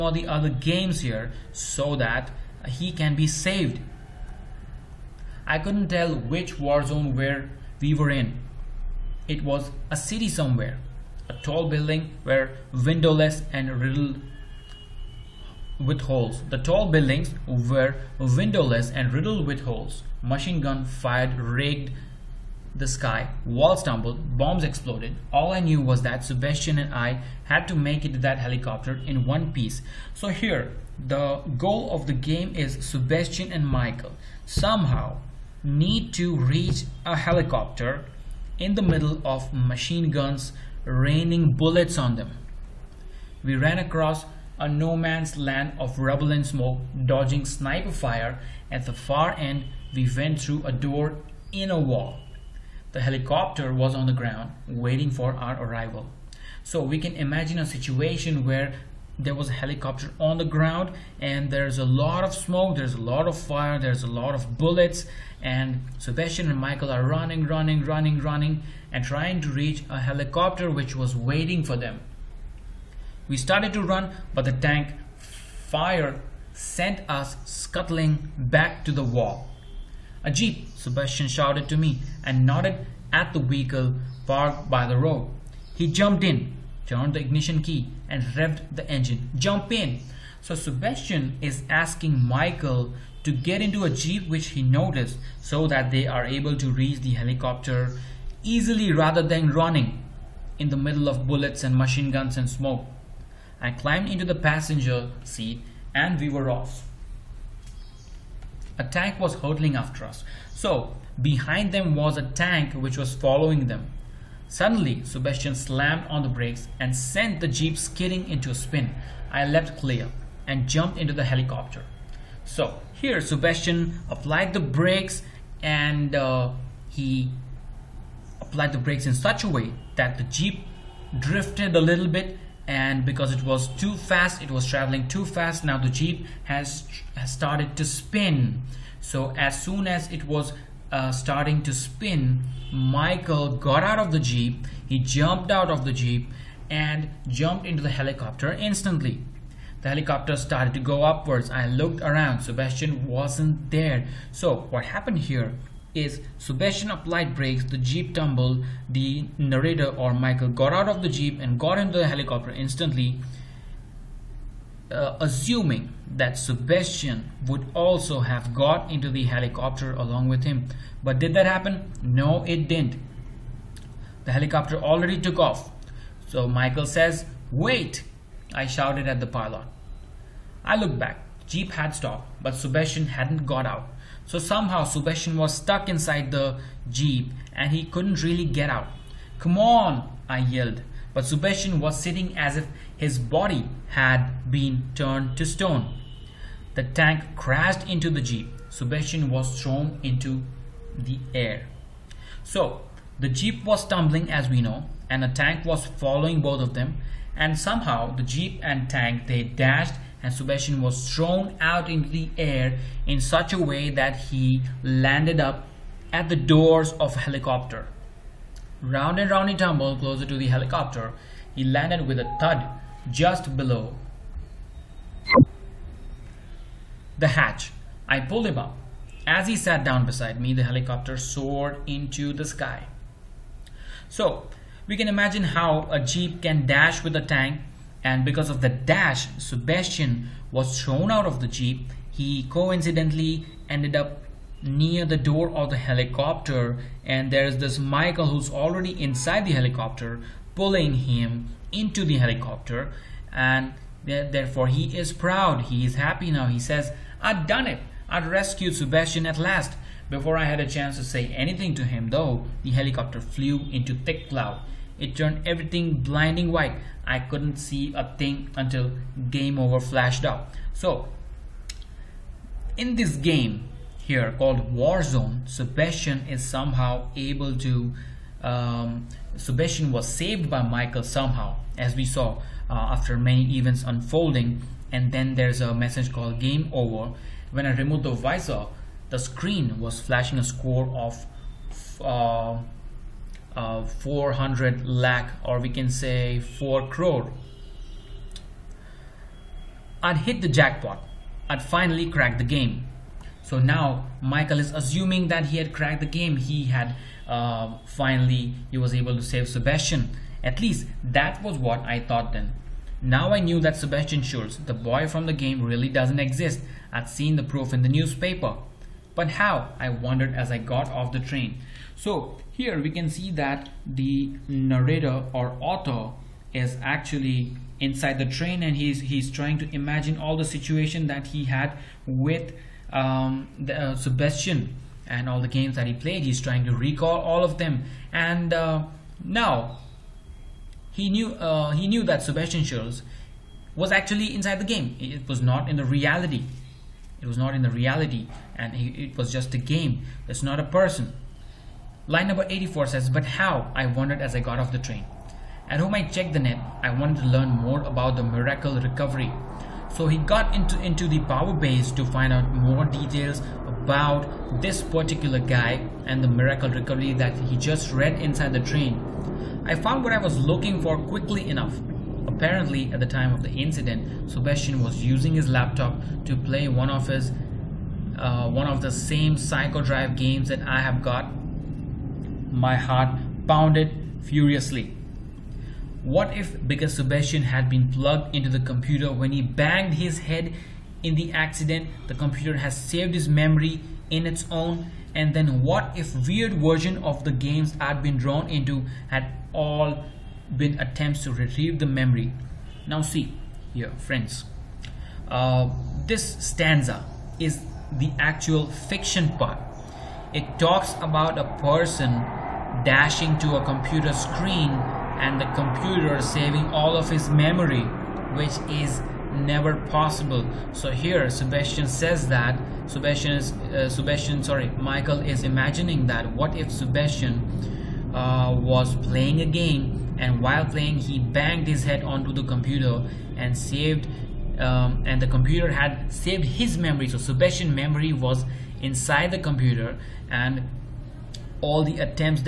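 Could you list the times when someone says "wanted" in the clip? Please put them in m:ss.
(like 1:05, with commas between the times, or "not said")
5:56.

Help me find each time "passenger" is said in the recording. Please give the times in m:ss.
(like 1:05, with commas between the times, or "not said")
1:44.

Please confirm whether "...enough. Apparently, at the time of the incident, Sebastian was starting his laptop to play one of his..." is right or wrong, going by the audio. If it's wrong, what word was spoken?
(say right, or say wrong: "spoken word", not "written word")
wrong: "using", not "starting".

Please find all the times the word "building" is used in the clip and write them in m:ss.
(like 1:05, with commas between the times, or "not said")
0:11, 0:16.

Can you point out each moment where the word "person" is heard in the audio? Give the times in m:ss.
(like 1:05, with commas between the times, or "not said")
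5:50, 6:51.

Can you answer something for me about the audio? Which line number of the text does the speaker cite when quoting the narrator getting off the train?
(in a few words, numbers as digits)
84.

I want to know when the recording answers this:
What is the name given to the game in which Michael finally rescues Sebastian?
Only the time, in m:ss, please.
4:34.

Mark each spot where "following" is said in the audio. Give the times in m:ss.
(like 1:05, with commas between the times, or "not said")
1:53, 3:25.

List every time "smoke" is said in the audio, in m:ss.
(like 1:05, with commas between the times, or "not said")
0:46, 1:02, 1:42.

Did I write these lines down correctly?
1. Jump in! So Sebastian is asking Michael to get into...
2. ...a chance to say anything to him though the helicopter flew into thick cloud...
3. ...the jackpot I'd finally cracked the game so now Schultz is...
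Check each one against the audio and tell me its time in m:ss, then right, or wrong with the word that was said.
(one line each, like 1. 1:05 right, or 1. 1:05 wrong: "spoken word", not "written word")
1. 1:29 right
2. 4:20 right
3. 5:00 wrong: "Michael", not "Schultz".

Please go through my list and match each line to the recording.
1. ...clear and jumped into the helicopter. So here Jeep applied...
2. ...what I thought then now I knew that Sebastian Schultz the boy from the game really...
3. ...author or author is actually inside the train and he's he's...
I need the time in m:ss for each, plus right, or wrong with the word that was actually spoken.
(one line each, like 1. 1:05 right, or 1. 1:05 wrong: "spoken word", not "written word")
1. 1:59 wrong: "Sebastian", not "Jeep"
2. 5:11 right
3. 5:24 wrong: "narrator", not "author".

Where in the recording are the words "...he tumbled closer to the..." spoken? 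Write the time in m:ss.
3:39.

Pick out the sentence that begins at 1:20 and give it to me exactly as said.
A jeep, Sebastian shouted to me and nodded at the vehicle parked by the road.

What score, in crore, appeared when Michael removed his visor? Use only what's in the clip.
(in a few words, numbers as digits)
4 crore.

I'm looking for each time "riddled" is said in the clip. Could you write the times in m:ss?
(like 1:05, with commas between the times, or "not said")
0:13, 0:19.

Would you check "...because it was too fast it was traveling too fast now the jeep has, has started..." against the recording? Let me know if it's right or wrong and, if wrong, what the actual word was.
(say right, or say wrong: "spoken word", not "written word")
right.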